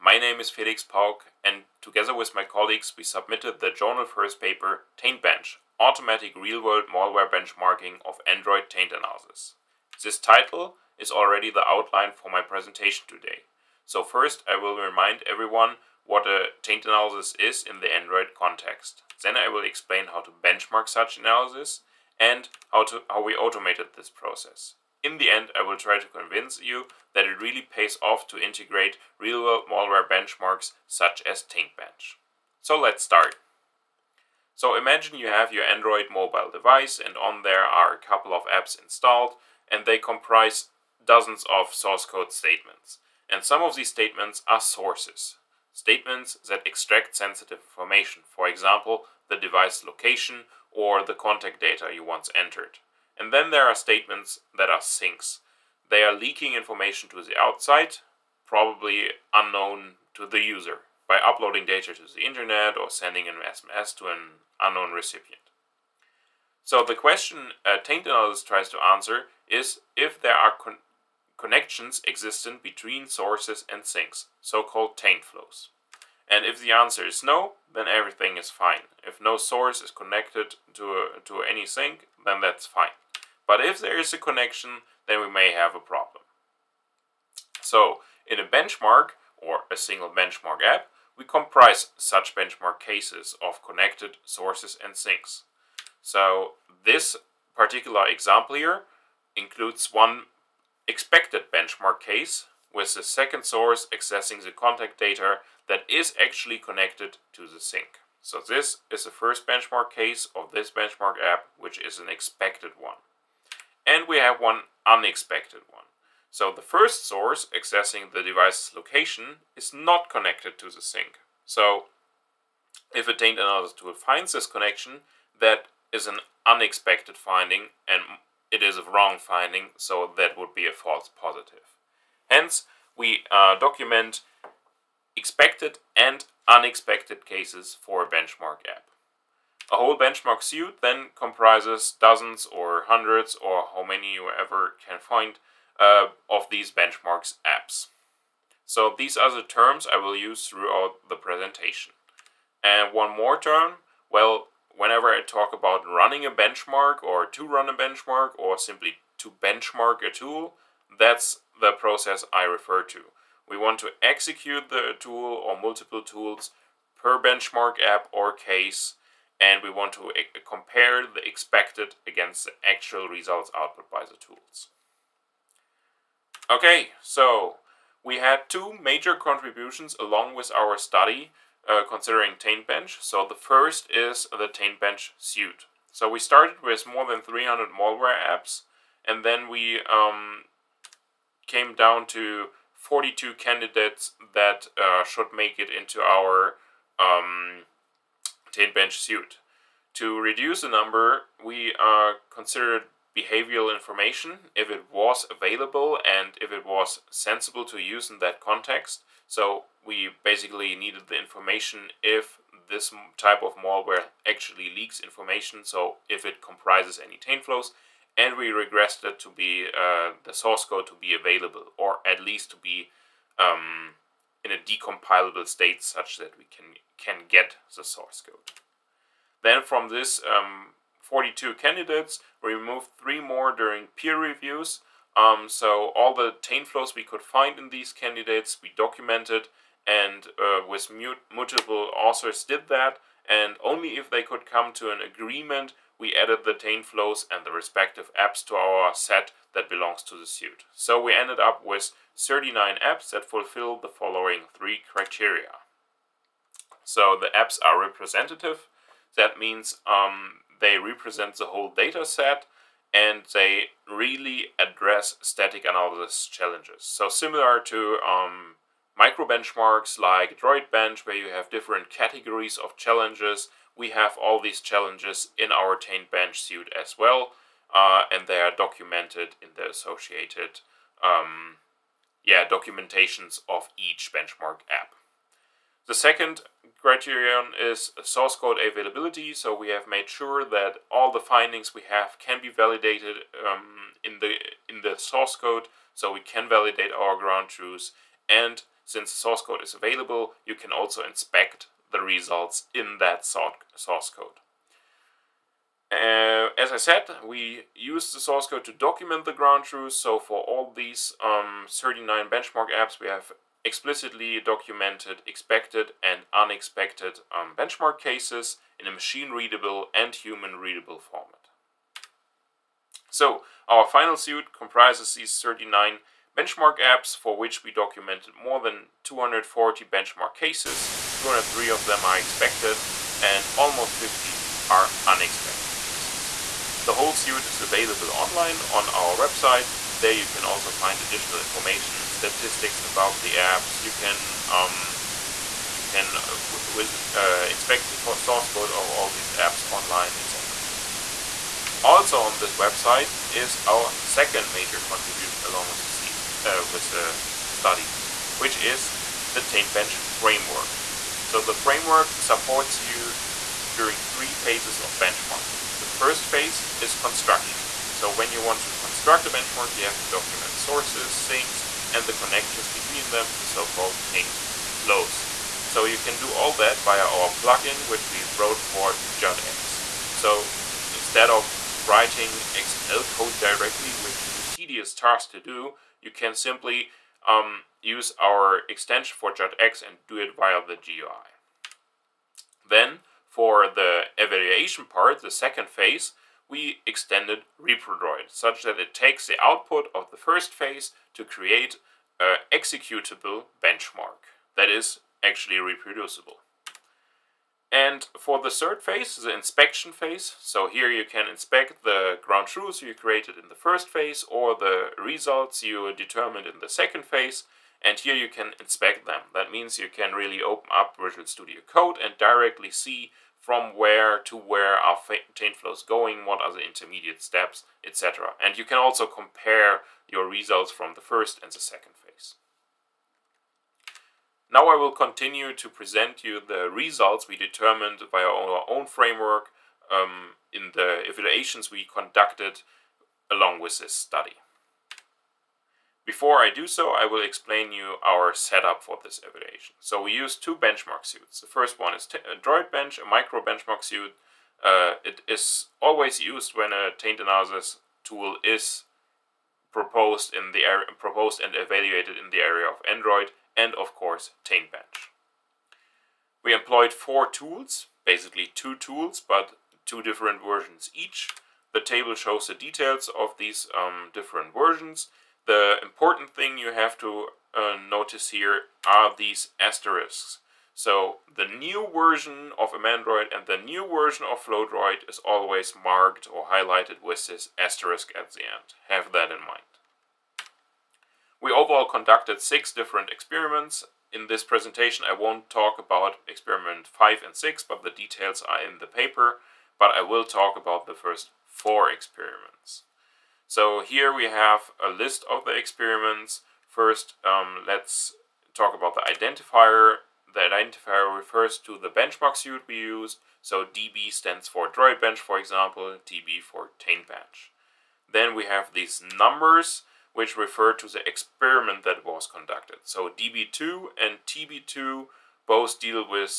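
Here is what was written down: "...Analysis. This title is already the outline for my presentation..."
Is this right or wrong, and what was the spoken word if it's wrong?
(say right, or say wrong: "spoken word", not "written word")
right.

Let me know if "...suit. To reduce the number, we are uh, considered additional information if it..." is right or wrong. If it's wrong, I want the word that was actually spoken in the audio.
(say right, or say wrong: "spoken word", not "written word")
wrong: "behavioral", not "additional".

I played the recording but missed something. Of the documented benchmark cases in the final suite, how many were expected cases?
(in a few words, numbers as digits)
203.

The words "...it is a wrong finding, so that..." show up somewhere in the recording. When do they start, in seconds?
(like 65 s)
128 s.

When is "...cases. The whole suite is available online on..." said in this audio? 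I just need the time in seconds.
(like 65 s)
335 s.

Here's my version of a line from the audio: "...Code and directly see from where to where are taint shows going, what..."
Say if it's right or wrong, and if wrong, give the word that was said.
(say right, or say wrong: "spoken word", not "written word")
wrong: "flows", not "shows".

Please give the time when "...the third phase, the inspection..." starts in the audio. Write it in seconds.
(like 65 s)
408 s.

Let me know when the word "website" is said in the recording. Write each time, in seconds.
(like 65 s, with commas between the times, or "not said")
339 s, 352 s.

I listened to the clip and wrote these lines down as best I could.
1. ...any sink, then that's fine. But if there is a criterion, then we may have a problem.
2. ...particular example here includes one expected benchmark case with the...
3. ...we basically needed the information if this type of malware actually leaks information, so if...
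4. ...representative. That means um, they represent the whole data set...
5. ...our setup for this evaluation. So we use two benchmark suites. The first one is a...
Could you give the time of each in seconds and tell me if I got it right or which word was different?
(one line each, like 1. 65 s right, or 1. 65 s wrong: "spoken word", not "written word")
1. 81 s wrong: "connection", not "criterion"
2. 97 s right
3. 209 s right
4. 257 s right
5. 448 s right.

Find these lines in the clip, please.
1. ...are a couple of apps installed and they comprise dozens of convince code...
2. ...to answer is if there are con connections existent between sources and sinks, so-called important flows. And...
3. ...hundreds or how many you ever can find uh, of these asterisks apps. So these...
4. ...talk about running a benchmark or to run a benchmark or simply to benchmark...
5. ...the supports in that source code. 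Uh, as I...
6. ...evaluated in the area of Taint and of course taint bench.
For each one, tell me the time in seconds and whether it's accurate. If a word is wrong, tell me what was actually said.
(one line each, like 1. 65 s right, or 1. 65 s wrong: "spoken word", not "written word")
1. 37 s wrong: "source", not "convince"
2. 68 s wrong: "taint", not "important"
3. 142 s wrong: "benchmarks", not "asterisks"
4. 155 s right
5. 301 s wrong: "results", not "supports"
6. 461 s wrong: "Android", not "Taint".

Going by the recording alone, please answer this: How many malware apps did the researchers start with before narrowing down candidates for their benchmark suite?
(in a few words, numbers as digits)
more than 300.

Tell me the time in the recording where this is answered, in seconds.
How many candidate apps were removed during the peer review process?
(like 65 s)
233 s.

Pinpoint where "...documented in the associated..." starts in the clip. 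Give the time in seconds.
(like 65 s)
278 s.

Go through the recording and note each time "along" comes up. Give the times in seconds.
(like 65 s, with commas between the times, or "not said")
179 s, 355 s, 443 s.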